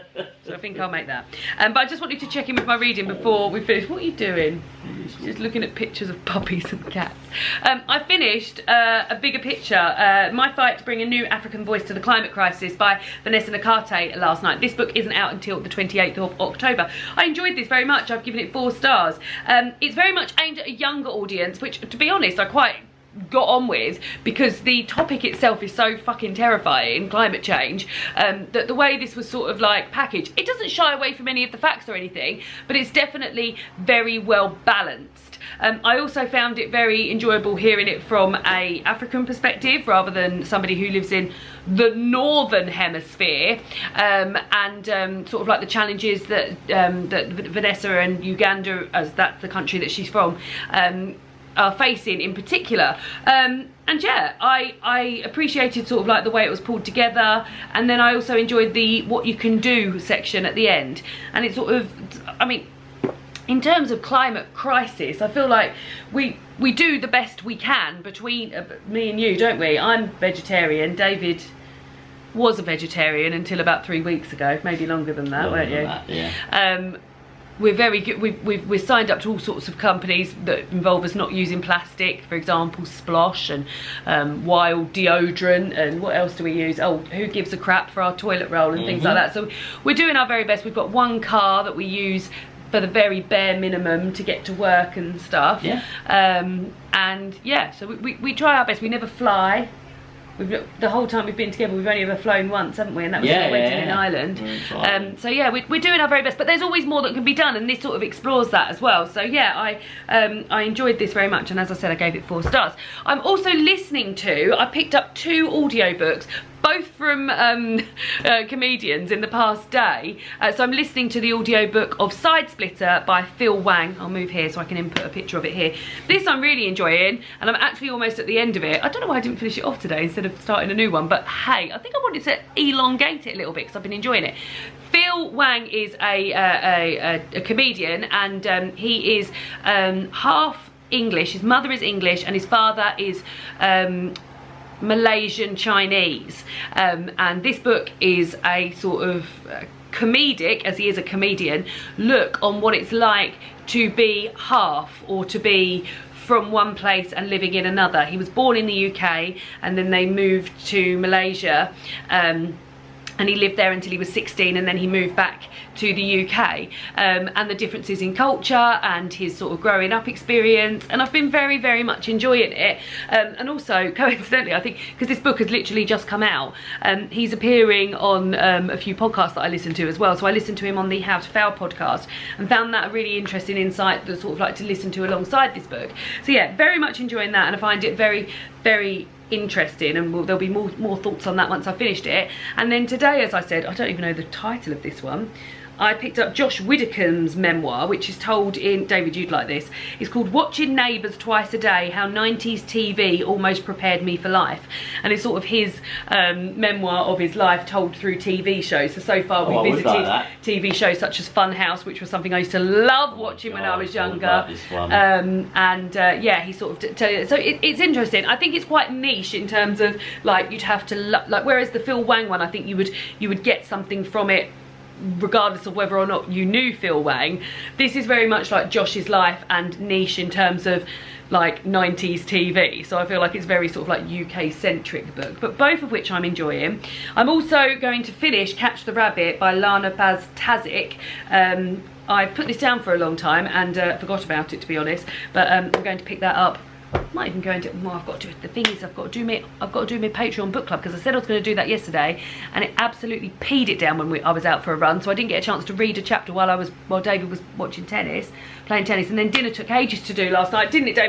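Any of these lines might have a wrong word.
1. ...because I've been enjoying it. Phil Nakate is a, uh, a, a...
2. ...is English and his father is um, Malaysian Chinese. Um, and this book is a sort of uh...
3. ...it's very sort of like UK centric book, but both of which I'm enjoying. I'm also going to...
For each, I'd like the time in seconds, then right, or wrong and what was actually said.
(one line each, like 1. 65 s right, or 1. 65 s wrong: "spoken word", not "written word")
1. 133 s wrong: "Wang", not "Nakate"
2. 141 s right
3. 233 s right.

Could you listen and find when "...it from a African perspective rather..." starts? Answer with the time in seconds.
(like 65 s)
37 s.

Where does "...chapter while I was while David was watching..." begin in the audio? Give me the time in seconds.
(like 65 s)
256 s.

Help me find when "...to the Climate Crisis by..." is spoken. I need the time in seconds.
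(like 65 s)
11 s.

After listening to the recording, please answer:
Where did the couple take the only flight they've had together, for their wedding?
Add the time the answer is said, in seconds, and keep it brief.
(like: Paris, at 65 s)
Ireland, at 103 s.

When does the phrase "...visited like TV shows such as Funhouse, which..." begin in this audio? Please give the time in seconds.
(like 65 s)
209 s.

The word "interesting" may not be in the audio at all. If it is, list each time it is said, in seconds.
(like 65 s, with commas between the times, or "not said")
183 s, 189 s, 217 s.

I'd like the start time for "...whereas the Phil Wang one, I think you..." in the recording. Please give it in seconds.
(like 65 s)
221 s.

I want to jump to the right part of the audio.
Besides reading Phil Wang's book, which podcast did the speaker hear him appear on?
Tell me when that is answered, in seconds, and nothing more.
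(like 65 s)
180 s.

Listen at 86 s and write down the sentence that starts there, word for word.
Oh, who gives a crap for our toilet roll and mm -hmm.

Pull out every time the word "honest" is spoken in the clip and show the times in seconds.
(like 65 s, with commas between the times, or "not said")
22 s, 244 s.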